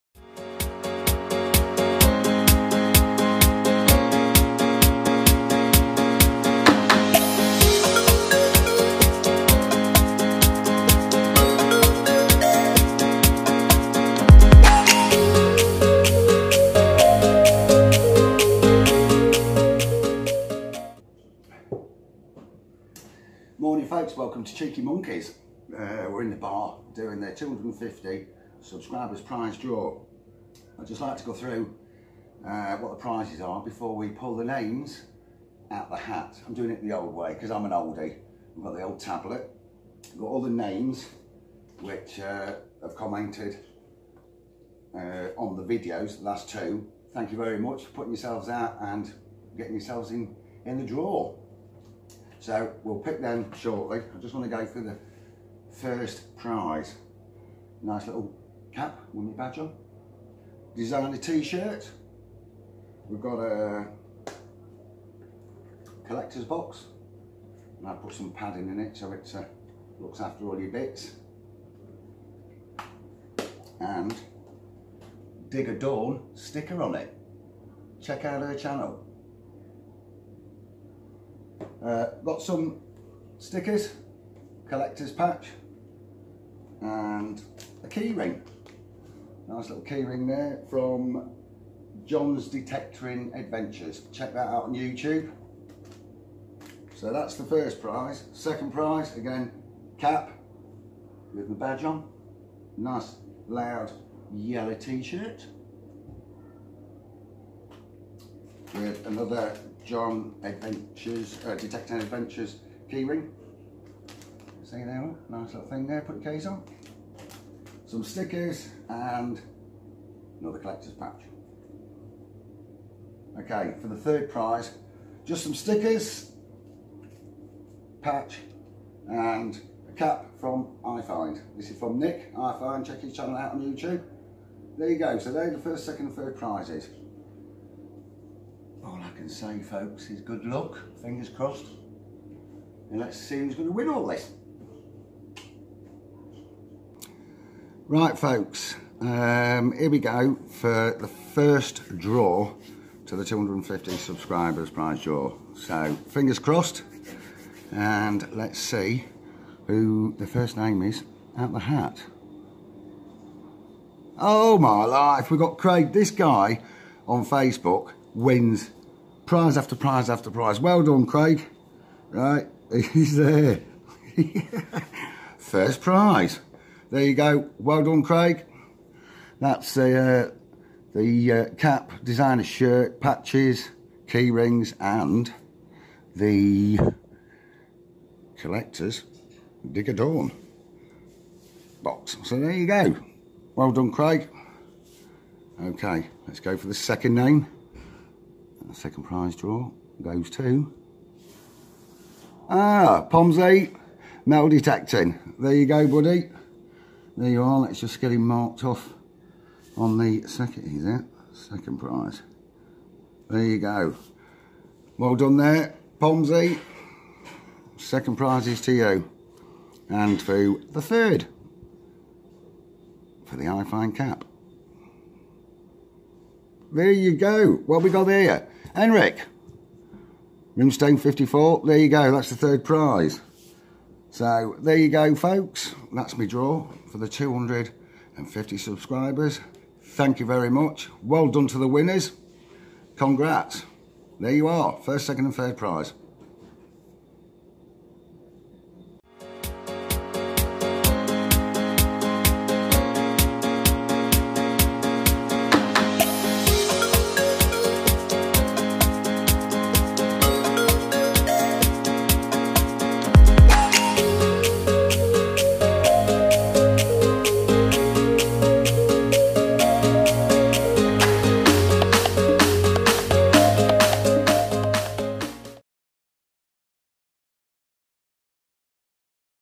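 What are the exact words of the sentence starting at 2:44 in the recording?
Oh my life, we've got Craig, this guy on Facebook wins prize after prize after prize.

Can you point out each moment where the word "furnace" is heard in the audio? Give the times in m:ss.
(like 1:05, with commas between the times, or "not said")
not said.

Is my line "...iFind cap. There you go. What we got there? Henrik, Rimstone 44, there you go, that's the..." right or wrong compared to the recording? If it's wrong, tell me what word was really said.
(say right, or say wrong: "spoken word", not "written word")
wrong: "54", not "44".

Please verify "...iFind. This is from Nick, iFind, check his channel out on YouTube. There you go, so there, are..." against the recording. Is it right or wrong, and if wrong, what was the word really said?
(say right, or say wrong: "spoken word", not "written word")
right.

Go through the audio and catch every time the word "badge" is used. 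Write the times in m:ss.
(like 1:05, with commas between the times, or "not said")
0:59, 1:41.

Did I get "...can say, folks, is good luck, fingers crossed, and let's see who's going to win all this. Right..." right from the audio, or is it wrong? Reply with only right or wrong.
right.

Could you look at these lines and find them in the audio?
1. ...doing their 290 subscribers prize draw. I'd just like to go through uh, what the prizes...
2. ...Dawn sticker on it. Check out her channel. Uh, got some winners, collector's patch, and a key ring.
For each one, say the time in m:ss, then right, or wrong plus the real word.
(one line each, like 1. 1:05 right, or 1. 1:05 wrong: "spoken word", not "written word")
1. 0:26 wrong: "250", not "290"
2. 1:15 wrong: "stickers", not "winners".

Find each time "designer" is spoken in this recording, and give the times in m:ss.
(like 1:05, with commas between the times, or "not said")
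1:00, 3:02.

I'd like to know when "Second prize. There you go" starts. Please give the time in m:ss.
3:31.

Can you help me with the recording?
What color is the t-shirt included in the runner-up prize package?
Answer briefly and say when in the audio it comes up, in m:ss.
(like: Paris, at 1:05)
Yellow, at 1:44.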